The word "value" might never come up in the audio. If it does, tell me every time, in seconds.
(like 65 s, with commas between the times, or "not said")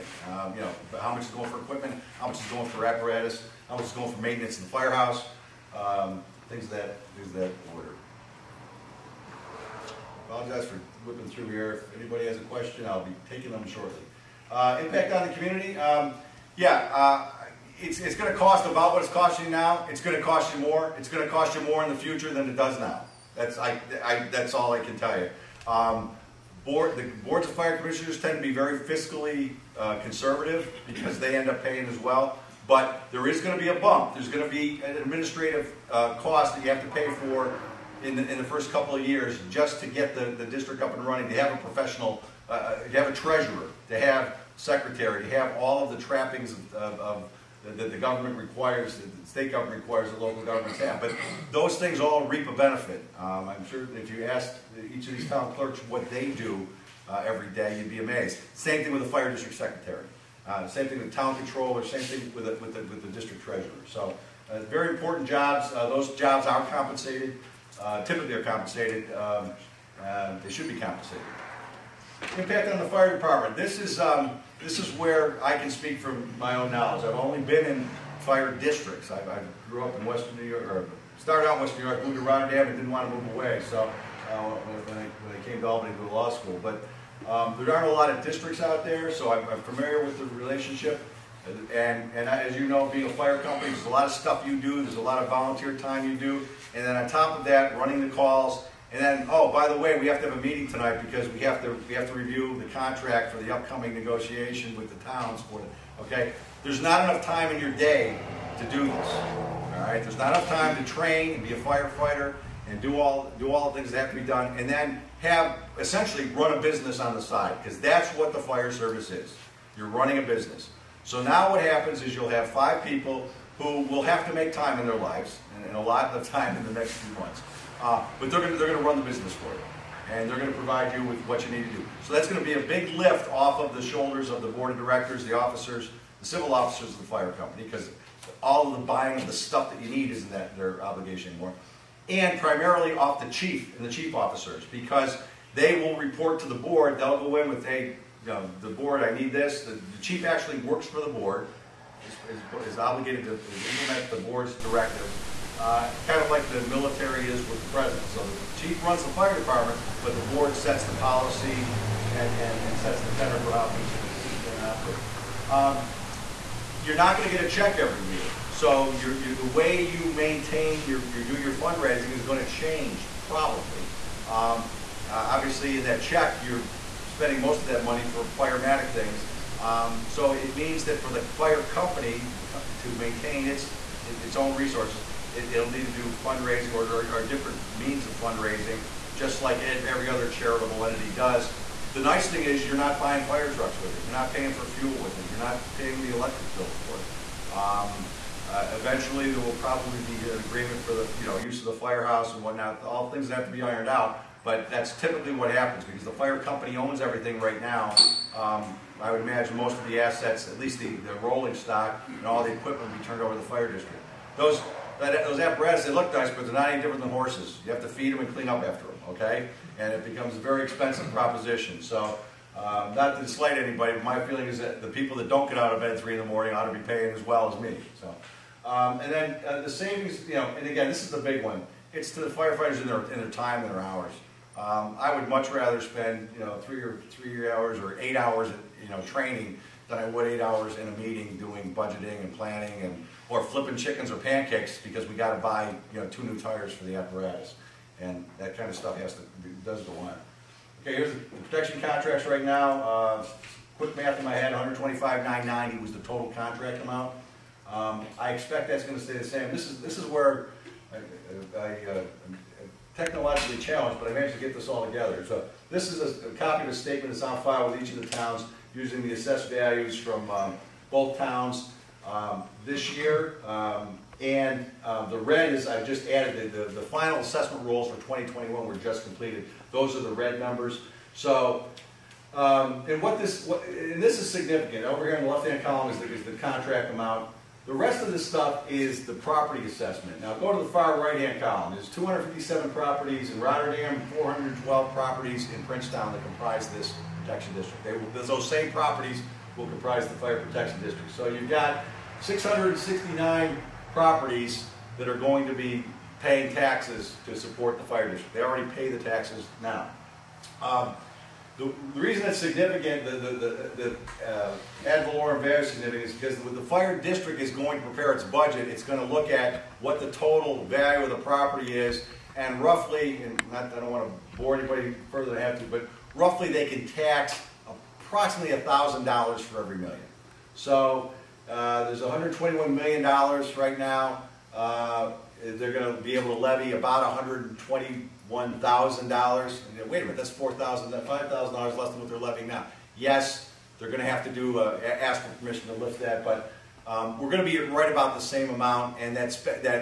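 269 s, 315 s, 320 s.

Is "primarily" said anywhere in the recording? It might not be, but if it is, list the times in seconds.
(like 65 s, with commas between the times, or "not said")
142 s.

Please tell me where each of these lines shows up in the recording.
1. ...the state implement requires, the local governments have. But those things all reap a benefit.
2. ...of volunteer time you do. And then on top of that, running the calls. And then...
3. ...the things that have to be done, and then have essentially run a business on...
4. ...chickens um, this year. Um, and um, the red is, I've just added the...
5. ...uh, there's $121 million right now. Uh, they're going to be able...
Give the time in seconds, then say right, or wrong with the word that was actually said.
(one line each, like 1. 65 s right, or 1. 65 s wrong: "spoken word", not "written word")
1. 48 s wrong: "government", not "implement"
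2. 95 s right
3. 113 s right
4. 271 s wrong: "towns", not "chickens"
5. 331 s right.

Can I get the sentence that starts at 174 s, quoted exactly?
Um, uh, obviously, in that check, you're spending most of that money for firematic things.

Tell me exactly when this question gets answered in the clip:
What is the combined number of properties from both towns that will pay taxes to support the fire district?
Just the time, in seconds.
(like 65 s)
302 s.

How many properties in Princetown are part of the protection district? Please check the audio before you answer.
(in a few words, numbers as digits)
412.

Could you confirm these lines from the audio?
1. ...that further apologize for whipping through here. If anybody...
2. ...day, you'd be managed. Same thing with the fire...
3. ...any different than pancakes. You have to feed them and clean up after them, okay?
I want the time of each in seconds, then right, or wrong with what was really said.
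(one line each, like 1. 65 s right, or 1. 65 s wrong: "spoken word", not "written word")
1. 7 s wrong: "order", not "further"
2. 57 s wrong: "amazed", not "managed"
3. 216 s wrong: "horses", not "pancakes".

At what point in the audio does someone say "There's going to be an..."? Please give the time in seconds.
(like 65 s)
34 s.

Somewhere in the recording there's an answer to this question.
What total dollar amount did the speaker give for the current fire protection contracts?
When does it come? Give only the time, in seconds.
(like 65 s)
254 s.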